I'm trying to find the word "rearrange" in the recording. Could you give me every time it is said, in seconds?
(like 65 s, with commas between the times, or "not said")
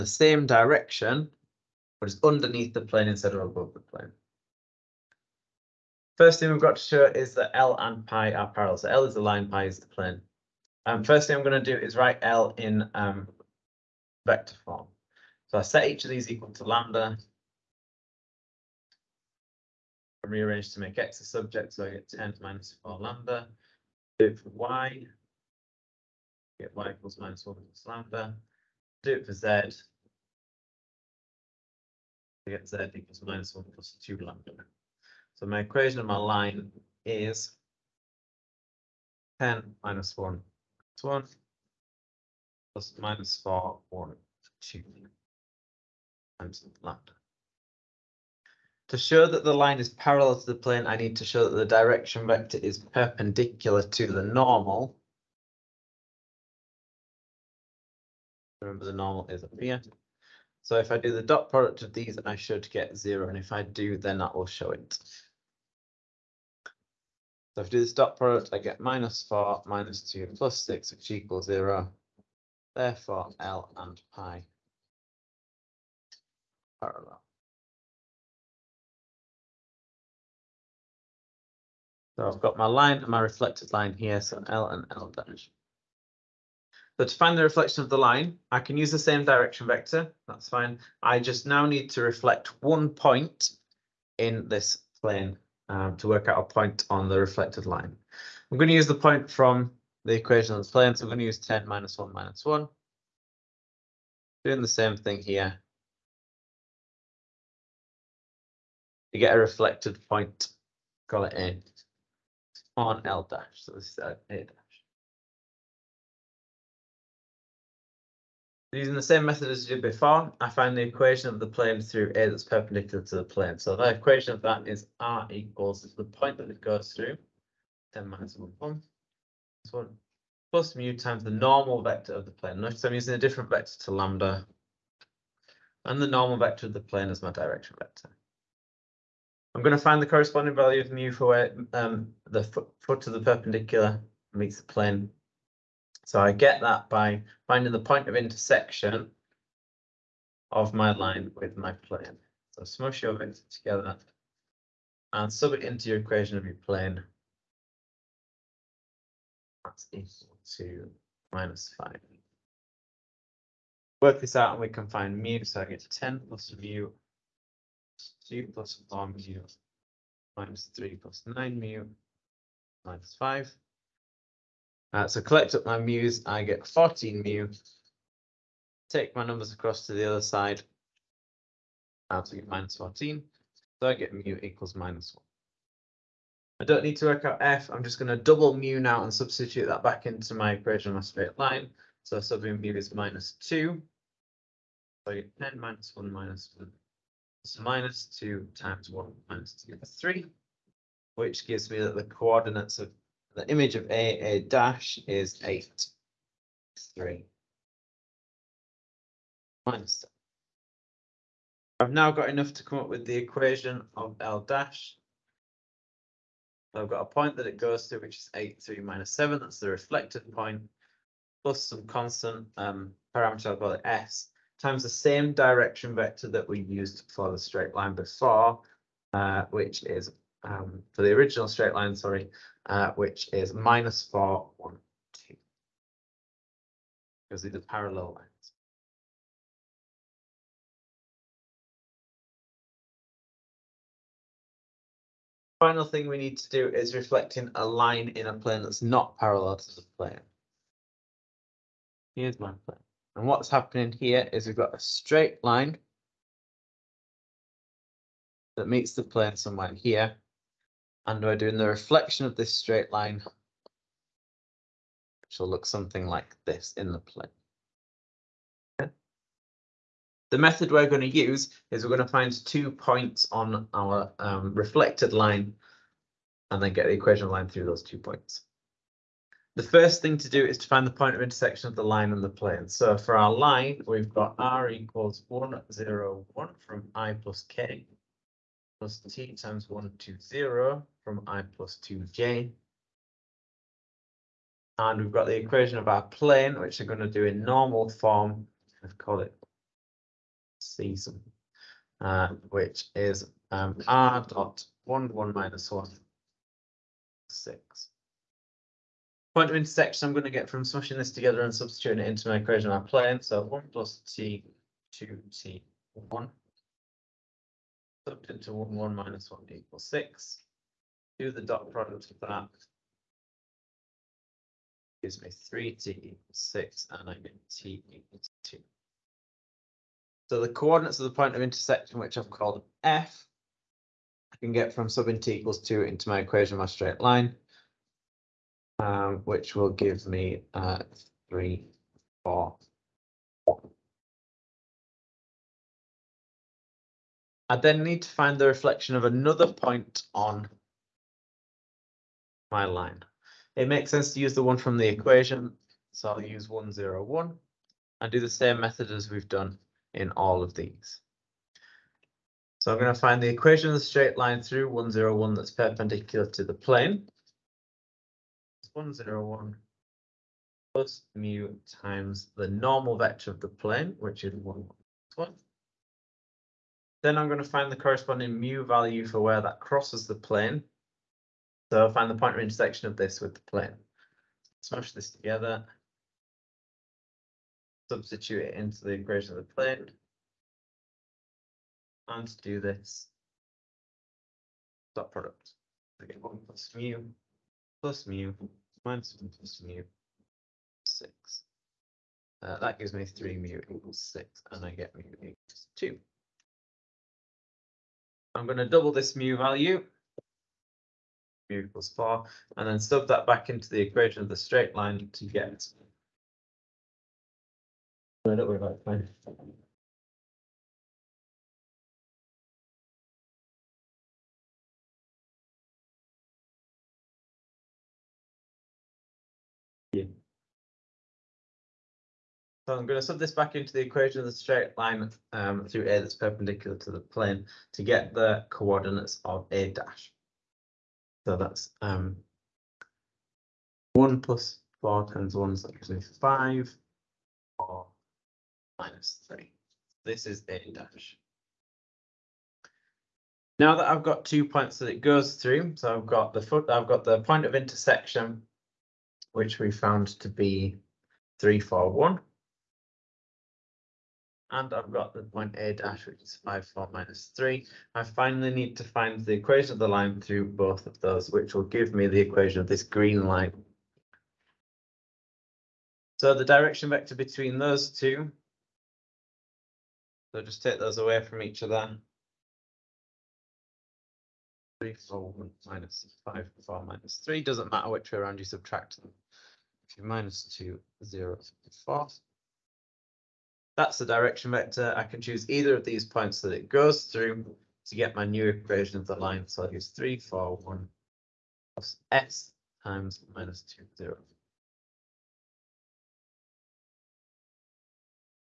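20 s.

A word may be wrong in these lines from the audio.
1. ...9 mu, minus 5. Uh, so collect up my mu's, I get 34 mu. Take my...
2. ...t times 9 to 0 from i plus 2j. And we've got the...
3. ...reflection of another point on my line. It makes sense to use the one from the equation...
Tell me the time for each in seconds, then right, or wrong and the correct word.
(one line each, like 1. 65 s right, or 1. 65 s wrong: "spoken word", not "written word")
1. 171 s wrong: "14", not "34"
2. 289 s wrong: "1", not "9"
3. 348 s right.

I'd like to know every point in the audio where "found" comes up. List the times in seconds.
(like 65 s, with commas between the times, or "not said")
459 s.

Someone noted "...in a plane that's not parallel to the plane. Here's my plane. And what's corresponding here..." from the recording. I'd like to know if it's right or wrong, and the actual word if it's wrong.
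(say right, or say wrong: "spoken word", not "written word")
wrong: "happening", not "corresponding".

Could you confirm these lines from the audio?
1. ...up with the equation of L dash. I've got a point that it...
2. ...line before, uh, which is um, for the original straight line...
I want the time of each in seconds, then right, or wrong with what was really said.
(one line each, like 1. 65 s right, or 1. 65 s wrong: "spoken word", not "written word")
1. 212 s right
2. 227 s right.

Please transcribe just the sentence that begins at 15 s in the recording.
So I set each of these equal to lambda.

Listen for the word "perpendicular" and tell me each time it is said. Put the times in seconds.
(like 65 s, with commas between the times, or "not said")
52 s, 122 s, 143 s, 365 s, 436 s.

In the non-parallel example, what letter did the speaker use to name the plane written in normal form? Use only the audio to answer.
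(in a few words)
c.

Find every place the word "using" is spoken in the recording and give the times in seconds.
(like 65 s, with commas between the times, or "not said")
118 s, 132 s.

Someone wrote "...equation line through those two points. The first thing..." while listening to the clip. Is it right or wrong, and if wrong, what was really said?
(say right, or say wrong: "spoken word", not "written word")
right.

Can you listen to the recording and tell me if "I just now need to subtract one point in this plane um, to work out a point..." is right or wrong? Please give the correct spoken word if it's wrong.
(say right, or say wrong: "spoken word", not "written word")
wrong: "reflect", not "subtract".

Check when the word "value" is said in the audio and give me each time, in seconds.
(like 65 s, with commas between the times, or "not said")
140 s, 378 s, 409 s.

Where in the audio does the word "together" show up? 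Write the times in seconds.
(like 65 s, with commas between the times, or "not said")
153 s, 311 s, 385 s.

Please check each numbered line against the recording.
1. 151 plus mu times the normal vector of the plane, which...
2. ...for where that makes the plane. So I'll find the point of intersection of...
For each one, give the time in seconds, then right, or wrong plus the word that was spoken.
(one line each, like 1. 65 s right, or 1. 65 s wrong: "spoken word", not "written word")
1. 368 s wrong: "101", not "151"
2. 379 s wrong: "crosses", not "makes".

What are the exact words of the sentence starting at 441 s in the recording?
So that's um, 1 plus 4 times 1, so that gives me 5, or minus 3.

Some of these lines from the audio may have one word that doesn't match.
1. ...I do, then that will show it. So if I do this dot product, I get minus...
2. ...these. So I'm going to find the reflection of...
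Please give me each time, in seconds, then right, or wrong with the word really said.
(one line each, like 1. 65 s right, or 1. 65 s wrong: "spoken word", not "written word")
1. 63 s right
2. 360 s wrong: "equation", not "reflection".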